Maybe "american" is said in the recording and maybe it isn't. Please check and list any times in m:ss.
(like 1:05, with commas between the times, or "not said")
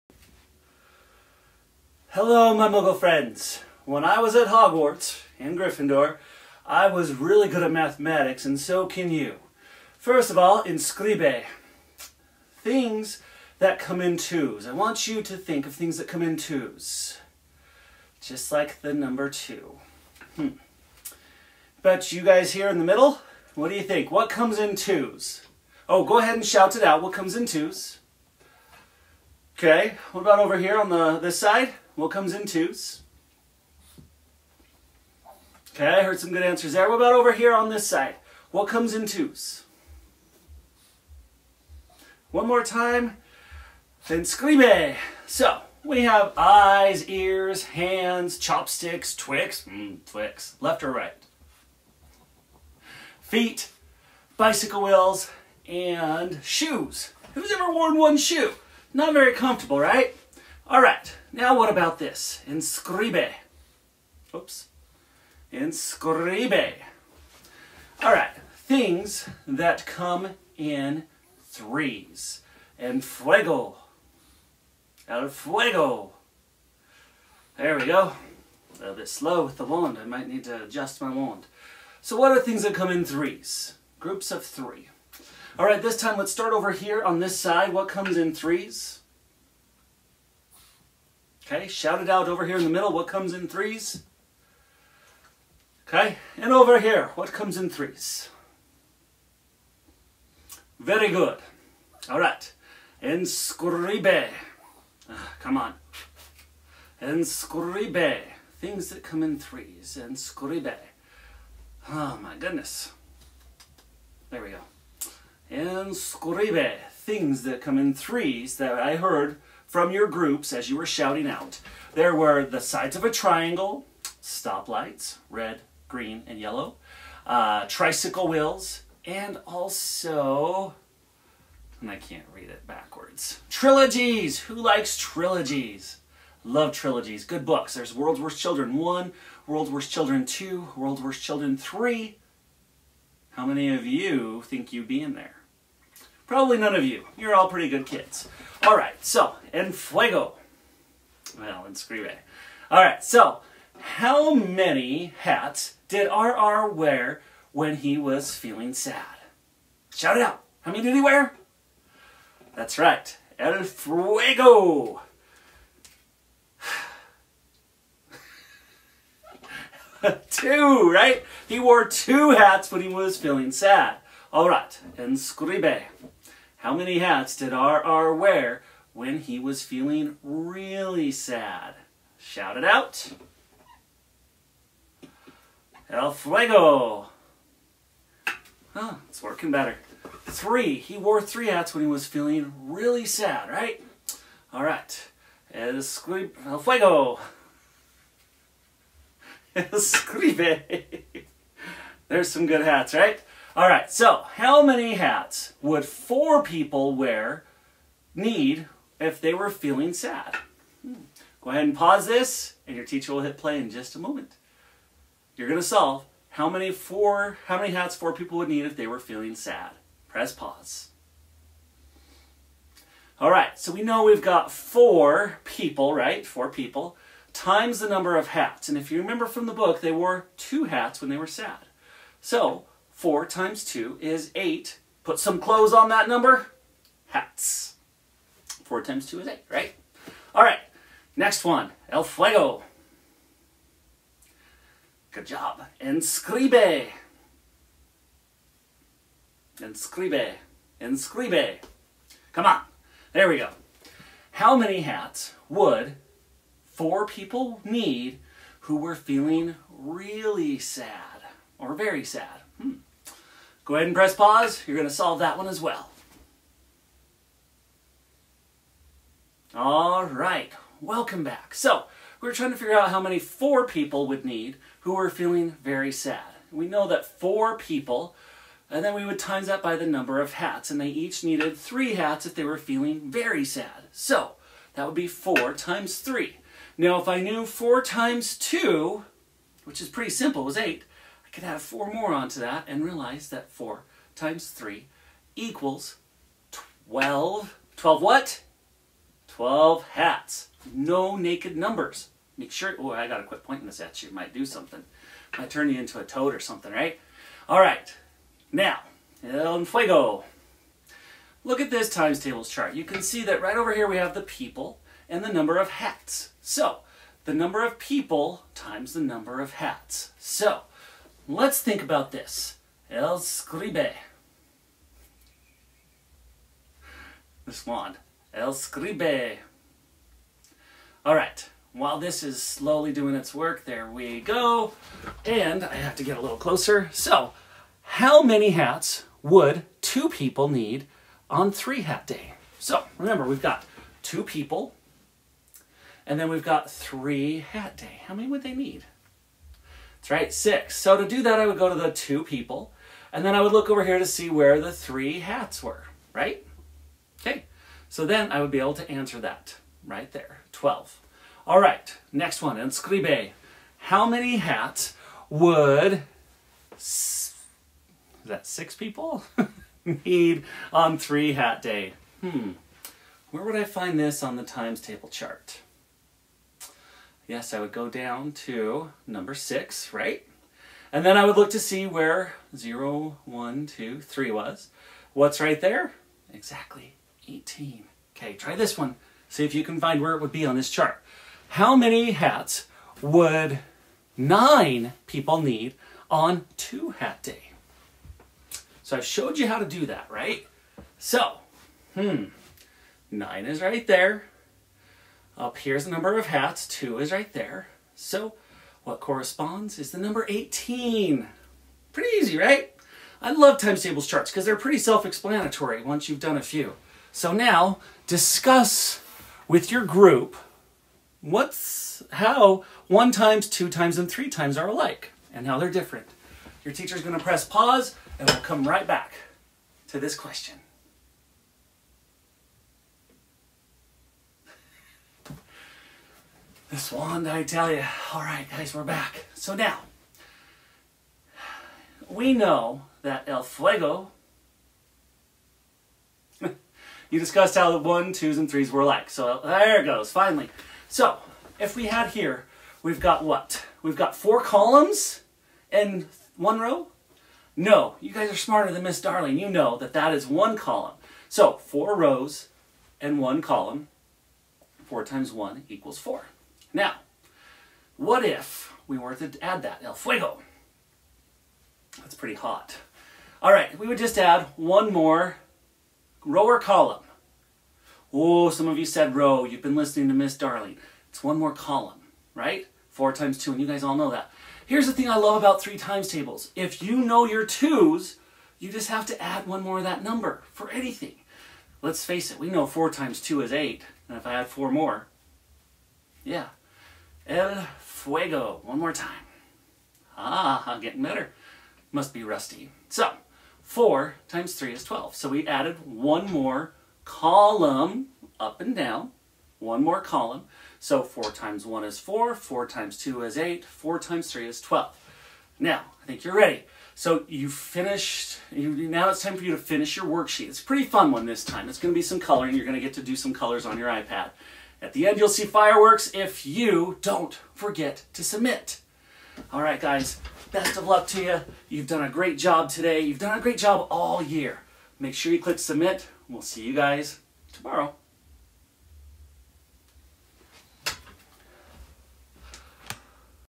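not said.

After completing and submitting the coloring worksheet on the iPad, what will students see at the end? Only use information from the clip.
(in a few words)
fireworks.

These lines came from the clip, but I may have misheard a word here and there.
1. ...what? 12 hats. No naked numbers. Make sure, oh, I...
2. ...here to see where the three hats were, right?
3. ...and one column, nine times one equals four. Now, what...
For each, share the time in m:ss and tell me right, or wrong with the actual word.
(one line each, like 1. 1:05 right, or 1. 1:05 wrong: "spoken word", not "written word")
1. 4:58 right
2. 5:53 right
3. 7:43 wrong: "four", not "nine".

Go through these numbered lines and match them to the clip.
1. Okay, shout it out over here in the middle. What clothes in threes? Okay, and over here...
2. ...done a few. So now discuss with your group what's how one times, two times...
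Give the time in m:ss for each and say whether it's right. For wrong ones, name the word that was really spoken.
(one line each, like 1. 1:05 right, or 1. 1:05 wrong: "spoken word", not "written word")
1. 1:31 wrong: "comes", not "clothes"
2. 6:56 right.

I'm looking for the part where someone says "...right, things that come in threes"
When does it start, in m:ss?
1:08.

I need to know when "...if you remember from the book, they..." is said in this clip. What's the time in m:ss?
3:48.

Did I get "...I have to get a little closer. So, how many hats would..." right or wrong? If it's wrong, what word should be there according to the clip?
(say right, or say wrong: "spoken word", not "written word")
right.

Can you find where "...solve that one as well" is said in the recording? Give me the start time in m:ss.
4:24.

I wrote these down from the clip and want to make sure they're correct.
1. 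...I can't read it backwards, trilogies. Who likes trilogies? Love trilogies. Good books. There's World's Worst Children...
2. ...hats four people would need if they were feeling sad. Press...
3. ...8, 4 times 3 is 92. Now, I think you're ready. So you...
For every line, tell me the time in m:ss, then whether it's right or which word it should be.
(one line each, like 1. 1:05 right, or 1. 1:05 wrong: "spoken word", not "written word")
1. 2:11 right
2. 3:37 right
3. 8:33 wrong: "12", not "92".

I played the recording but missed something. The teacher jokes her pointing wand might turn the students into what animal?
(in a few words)
a toad.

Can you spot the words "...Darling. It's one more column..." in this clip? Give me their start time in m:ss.
8:00.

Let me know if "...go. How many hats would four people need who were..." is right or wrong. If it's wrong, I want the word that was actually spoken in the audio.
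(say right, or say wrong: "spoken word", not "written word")
right.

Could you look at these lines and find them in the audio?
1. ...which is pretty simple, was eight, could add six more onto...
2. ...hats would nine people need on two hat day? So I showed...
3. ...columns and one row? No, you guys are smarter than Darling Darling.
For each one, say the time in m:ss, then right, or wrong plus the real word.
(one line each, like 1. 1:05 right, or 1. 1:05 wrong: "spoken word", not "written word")
1. 4:49 wrong: "four", not "six"
2. 6:32 right
3. 7:34 wrong: "Miss", not "Darling".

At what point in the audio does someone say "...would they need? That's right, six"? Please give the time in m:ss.
5:48.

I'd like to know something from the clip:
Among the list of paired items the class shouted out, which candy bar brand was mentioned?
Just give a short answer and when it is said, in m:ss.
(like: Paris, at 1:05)
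Twix, at 0:49.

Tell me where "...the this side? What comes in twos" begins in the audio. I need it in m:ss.
0:30.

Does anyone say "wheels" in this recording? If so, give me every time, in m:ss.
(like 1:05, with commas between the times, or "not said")
0:54, 2:08.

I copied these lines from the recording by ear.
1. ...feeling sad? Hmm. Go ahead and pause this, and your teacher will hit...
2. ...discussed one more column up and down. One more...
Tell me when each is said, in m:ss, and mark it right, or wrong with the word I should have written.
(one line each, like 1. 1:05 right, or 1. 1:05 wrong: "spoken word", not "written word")
1. 3:29 right
2. 8:25 wrong: "added", not "discussed".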